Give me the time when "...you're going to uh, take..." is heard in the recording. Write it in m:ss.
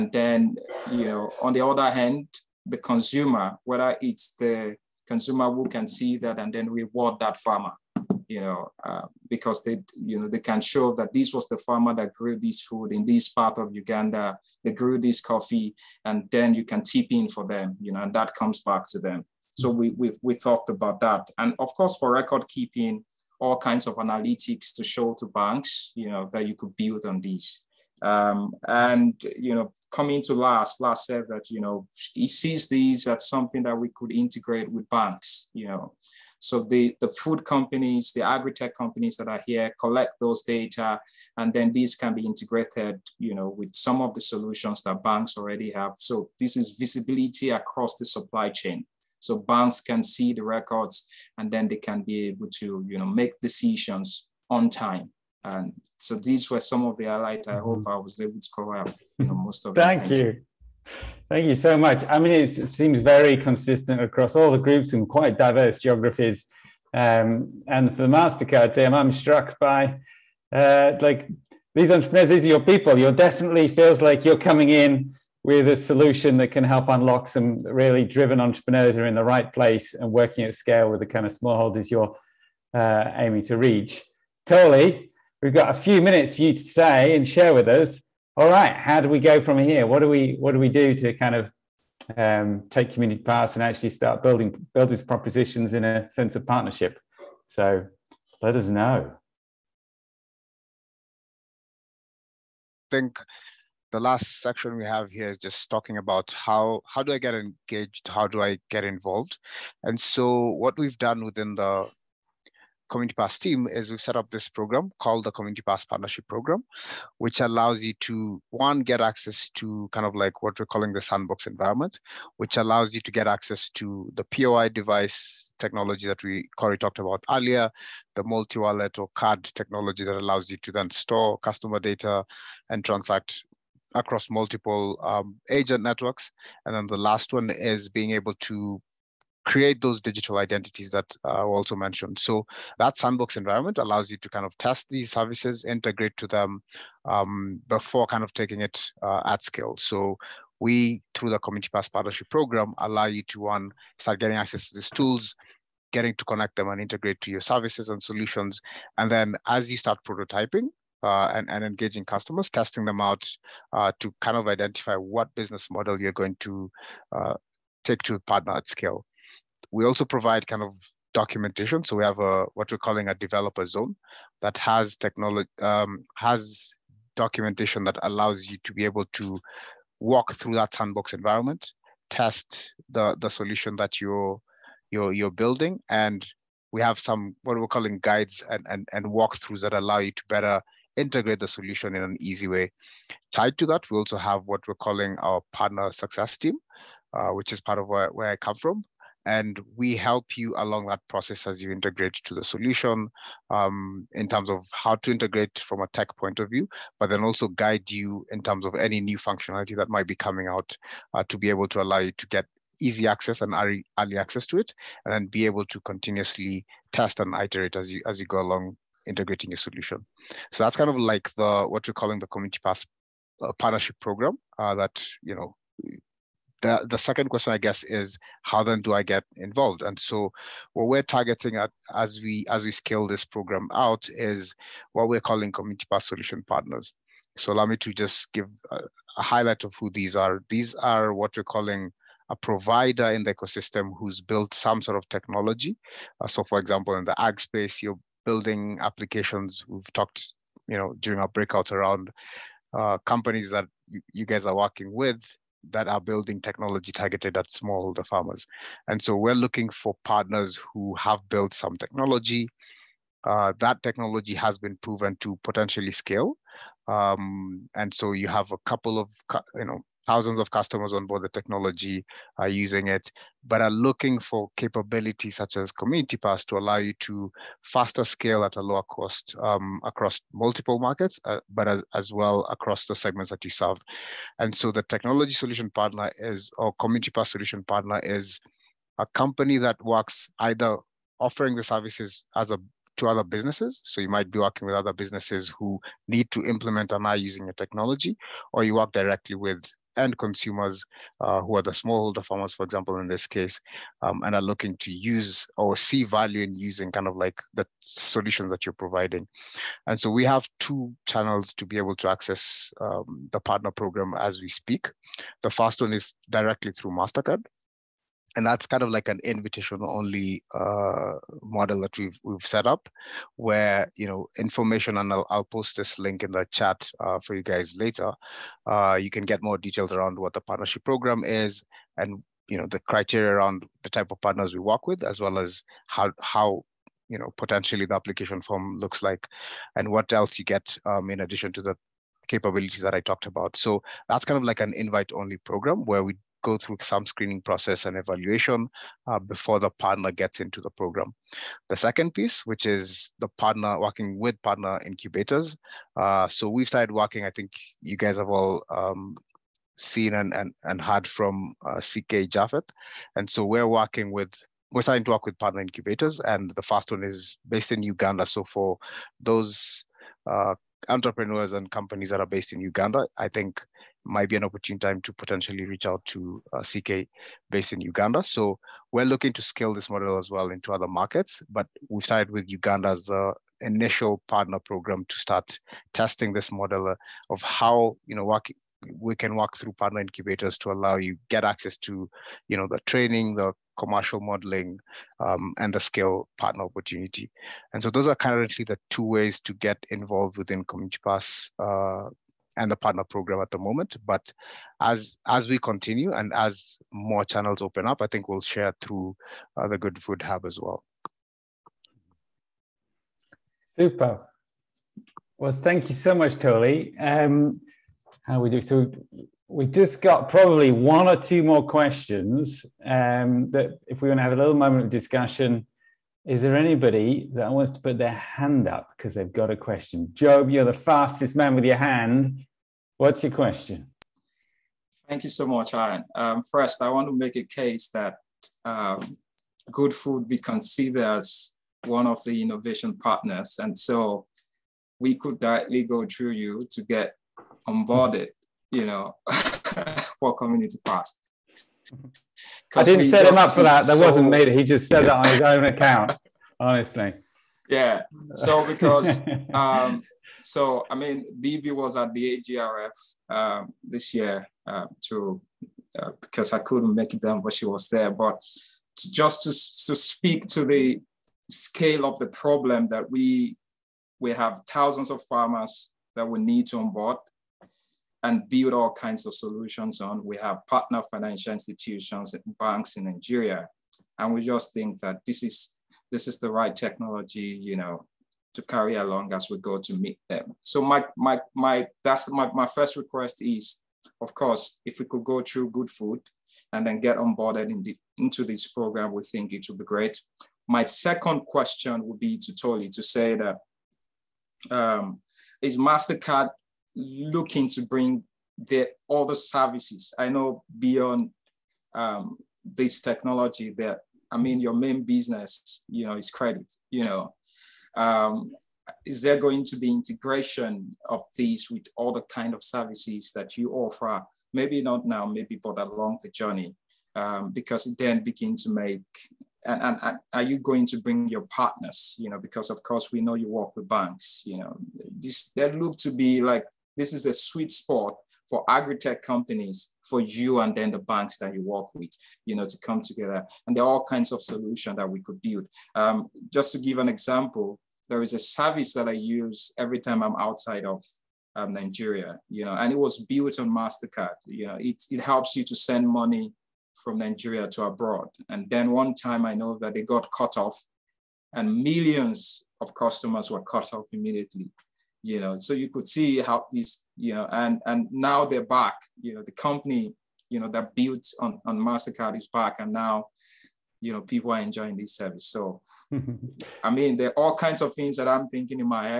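2:46.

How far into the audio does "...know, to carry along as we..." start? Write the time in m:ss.
8:07.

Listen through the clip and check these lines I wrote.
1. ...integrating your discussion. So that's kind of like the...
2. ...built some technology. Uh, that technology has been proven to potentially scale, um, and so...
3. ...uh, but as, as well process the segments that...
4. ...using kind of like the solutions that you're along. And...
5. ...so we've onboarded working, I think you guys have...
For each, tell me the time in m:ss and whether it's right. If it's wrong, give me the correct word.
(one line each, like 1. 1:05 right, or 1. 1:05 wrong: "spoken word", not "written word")
1. 3:39 wrong: "solution", not "discussion"
2. 4:21 right
3. 4:41 wrong: "across", not "process"
4. 5:06 wrong: "providing", not "along"
5. 5:56 wrong: "started", not "onboarded".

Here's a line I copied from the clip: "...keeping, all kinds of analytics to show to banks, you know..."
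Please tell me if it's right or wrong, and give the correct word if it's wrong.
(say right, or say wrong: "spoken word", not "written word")
right.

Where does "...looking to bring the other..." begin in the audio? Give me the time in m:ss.
8:26.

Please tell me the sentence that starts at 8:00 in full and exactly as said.
We have partner financial institutions and banks in Nigeria.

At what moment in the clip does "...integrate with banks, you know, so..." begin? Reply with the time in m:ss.
0:34.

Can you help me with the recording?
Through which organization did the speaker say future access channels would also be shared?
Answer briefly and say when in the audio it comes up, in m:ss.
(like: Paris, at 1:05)
Good Food Hub, at 6:49.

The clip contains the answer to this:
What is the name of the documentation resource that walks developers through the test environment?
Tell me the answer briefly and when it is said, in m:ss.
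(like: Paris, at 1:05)
developer zone, at 2:53.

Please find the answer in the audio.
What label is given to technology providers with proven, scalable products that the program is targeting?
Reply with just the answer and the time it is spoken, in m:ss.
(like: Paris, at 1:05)
Community Pass solution partners, at 3:55.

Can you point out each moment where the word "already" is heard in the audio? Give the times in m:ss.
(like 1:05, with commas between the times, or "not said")
0:45.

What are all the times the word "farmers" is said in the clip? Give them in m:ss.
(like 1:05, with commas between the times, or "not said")
0:07, 0:11, 4:18, 5:02, 7:55.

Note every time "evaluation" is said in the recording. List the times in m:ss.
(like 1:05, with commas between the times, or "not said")
5:47.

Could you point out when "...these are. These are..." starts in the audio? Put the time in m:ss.
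3:59.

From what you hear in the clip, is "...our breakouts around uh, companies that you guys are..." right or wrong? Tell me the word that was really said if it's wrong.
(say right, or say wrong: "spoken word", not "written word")
right.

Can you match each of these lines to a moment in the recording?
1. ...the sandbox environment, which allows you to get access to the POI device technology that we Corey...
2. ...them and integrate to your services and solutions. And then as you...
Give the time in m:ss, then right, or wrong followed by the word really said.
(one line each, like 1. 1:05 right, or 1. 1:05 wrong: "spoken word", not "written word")
1. 2:00 right
2. 2:36 right.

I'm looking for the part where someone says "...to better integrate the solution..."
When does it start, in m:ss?
3:10.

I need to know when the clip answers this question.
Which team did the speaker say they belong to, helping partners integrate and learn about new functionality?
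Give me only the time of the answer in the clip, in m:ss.
3:15.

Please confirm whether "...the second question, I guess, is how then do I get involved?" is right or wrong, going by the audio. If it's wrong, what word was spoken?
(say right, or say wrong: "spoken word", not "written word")
right.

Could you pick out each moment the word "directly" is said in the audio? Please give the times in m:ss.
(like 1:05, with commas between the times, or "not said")
4:58, 5:16, 7:25.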